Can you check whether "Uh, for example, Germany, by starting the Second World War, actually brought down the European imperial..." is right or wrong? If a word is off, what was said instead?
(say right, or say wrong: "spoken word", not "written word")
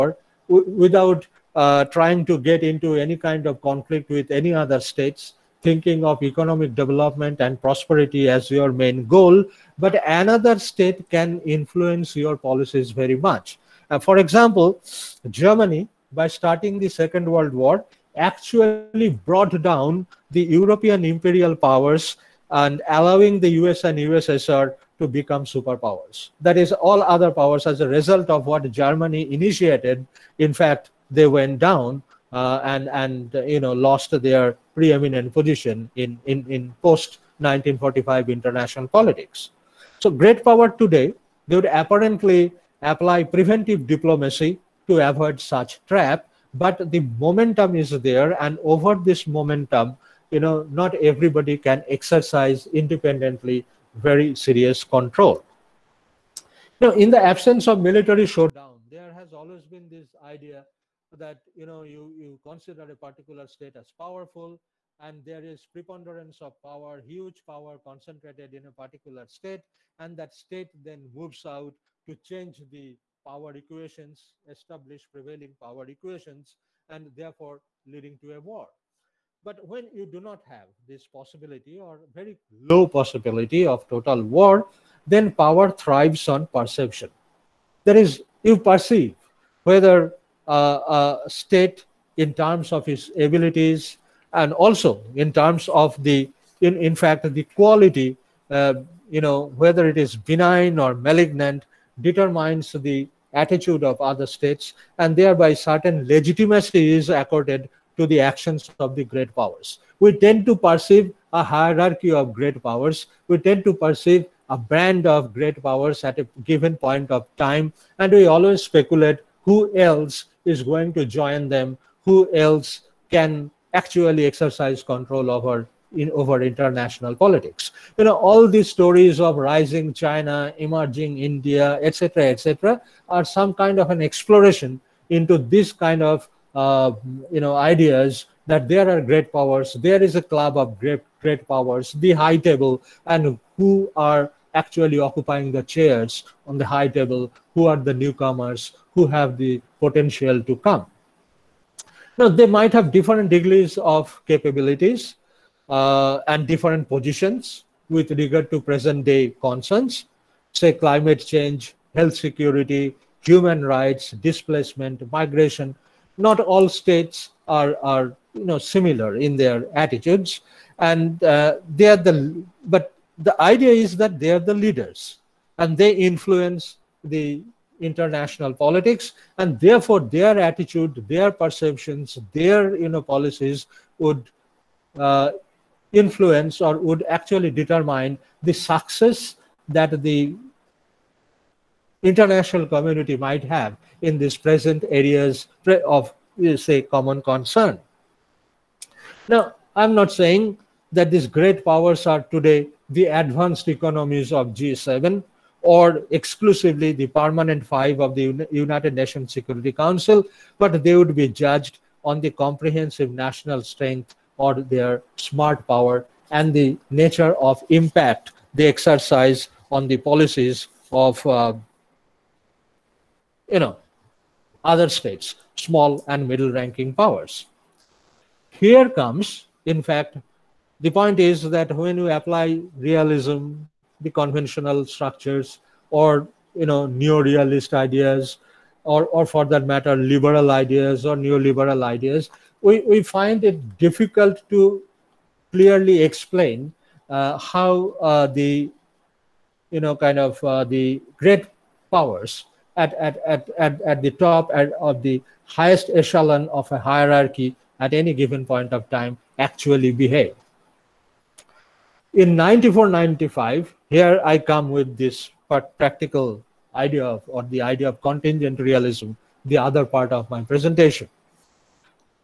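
right.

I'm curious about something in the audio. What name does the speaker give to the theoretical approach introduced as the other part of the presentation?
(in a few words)
contingent realism.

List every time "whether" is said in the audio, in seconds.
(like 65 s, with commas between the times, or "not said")
89 s, 99 s.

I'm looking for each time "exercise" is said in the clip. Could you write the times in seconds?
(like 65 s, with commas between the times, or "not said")
51 s, 124 s, 218 s.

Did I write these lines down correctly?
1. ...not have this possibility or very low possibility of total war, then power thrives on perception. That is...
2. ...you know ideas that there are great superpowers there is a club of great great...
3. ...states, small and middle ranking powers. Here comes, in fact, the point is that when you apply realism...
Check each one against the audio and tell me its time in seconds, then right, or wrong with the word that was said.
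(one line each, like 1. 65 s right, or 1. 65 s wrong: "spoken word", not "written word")
1. 80 s right
2. 137 s wrong: "powers", not "superpowers"
3. 224 s right.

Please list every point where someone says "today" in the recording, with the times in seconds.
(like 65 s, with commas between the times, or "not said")
40 s, 202 s.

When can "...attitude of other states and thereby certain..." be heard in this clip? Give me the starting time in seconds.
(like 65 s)
103 s.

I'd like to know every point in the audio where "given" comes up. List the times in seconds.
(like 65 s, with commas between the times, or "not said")
116 s, 258 s.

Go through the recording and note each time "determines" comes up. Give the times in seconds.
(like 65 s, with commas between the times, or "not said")
102 s, 187 s.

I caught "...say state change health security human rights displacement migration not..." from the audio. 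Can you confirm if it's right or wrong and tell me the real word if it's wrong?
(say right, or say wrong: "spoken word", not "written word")
wrong: "climate", not "state".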